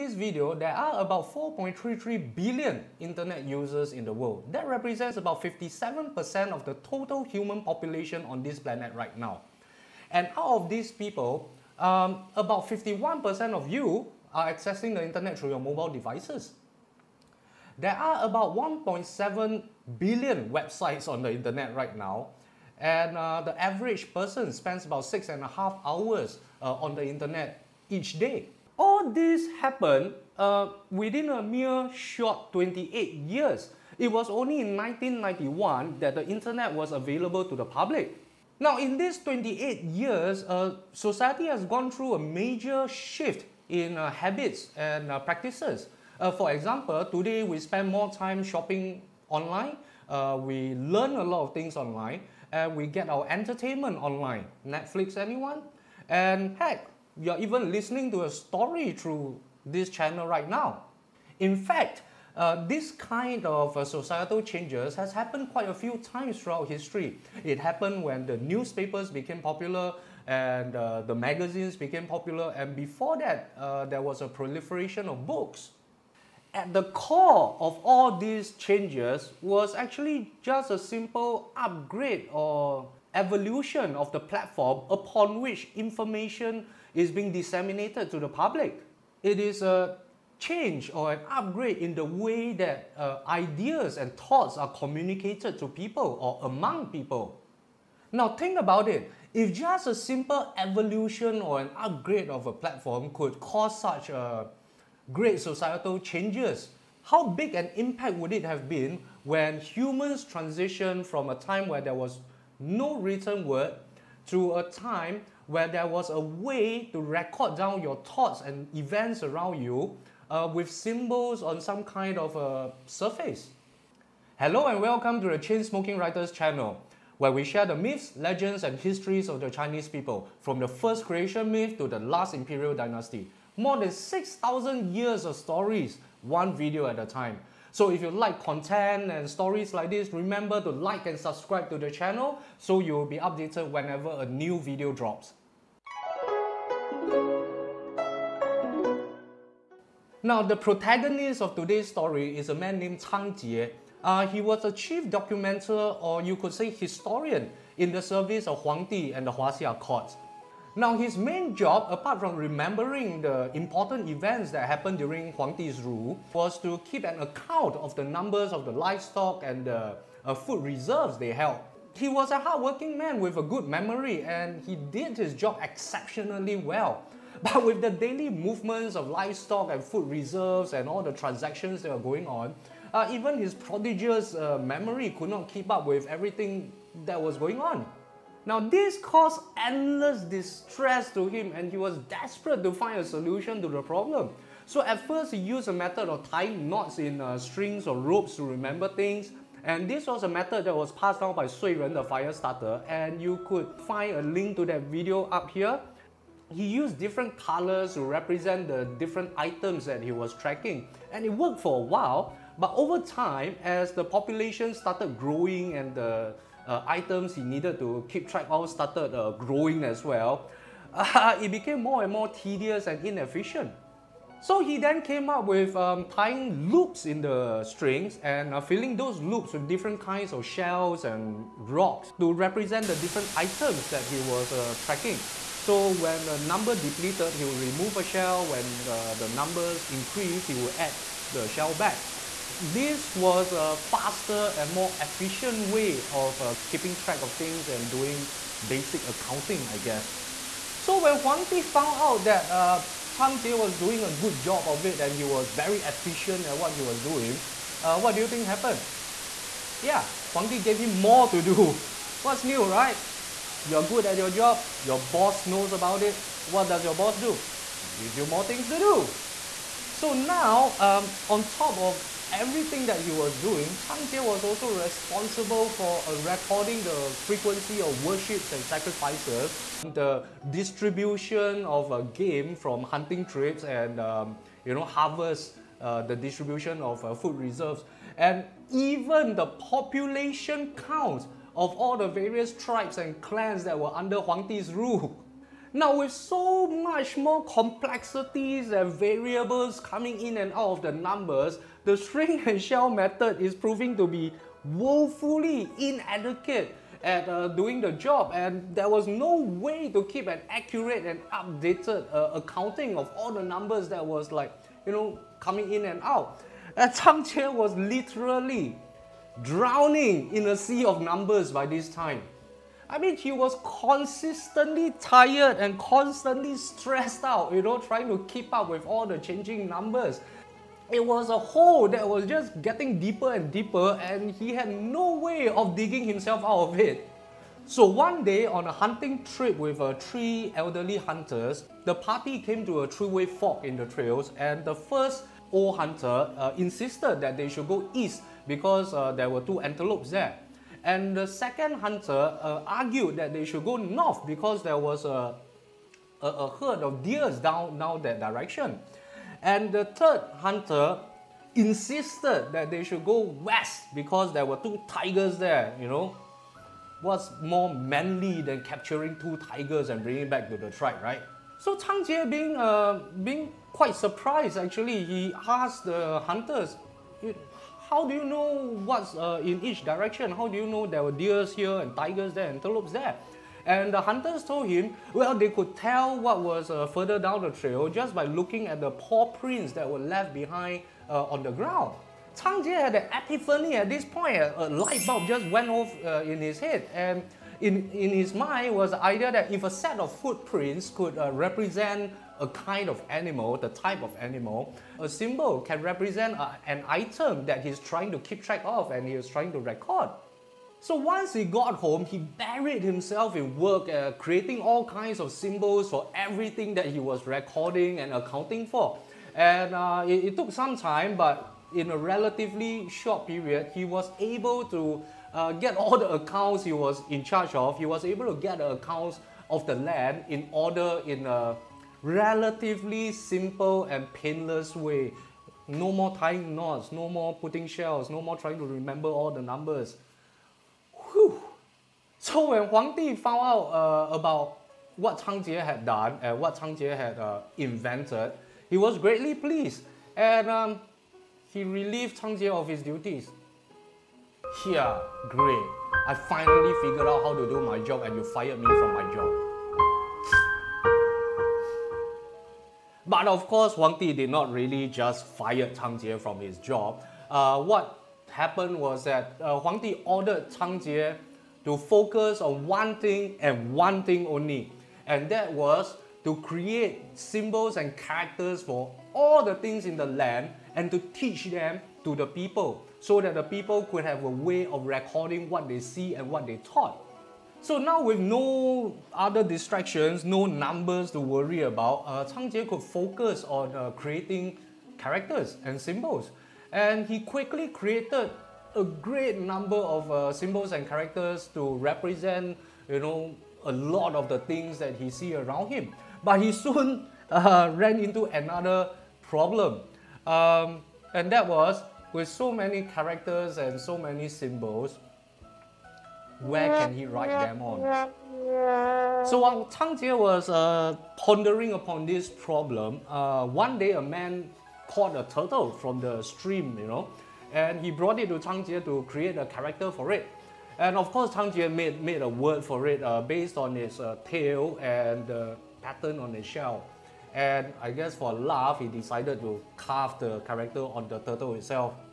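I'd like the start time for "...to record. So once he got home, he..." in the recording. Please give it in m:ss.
6:49.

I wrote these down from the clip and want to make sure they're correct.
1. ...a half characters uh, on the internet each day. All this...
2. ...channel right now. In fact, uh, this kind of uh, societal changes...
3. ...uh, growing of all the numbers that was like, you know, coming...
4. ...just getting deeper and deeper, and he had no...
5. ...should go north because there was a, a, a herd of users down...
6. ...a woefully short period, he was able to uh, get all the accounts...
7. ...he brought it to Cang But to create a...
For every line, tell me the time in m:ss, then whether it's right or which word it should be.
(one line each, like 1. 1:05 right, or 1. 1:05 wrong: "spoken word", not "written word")
1. 0:25 wrong: "hours", not "characters"
2. 0:59 right
3. 5:12 wrong: "accounting", not "growing"
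4. 5:32 right
5. 5:53 wrong: "deers", not "users"
6. 7:01 wrong: "relatively", not "woefully"
7. 8:47 wrong: "Jie", not "But".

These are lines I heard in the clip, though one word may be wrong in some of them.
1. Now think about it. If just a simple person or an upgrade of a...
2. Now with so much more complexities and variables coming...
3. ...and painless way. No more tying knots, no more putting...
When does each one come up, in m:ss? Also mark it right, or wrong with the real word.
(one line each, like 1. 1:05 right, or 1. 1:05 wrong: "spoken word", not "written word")
1. 1:38 wrong: "evolution", not "person"
2. 4:55 right
3. 7:13 right.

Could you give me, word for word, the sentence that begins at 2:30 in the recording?
Now, the protagonist of today's story is a man named Cang Jie.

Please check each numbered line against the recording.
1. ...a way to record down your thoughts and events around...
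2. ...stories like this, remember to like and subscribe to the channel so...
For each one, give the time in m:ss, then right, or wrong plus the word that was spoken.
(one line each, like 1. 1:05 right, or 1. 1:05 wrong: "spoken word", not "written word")
1. 1:56 right
2. 2:19 right.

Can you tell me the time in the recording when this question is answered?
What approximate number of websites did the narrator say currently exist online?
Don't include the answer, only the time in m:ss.
0:18.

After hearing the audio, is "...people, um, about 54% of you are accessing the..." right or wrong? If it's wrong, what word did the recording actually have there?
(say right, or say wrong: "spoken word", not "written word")
wrong: "51", not "54".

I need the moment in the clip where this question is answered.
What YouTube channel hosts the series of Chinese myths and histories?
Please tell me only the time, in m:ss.
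2:05.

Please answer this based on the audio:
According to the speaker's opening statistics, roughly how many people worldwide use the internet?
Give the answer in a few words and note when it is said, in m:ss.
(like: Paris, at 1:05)
4.33 billion, at 0:01.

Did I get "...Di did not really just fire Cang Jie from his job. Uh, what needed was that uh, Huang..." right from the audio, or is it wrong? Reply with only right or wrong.
wrong.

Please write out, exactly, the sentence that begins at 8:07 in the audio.
So now with no other distractions, no numbers to worry about, uh, Cang Jie could focus on uh, creating characters and symbols.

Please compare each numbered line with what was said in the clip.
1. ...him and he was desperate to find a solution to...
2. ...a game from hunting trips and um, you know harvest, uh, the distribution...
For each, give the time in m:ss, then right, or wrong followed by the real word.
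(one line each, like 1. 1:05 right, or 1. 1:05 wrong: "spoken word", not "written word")
1. 3:11 right
2. 4:41 right.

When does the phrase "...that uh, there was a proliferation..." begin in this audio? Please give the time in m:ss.
1:13.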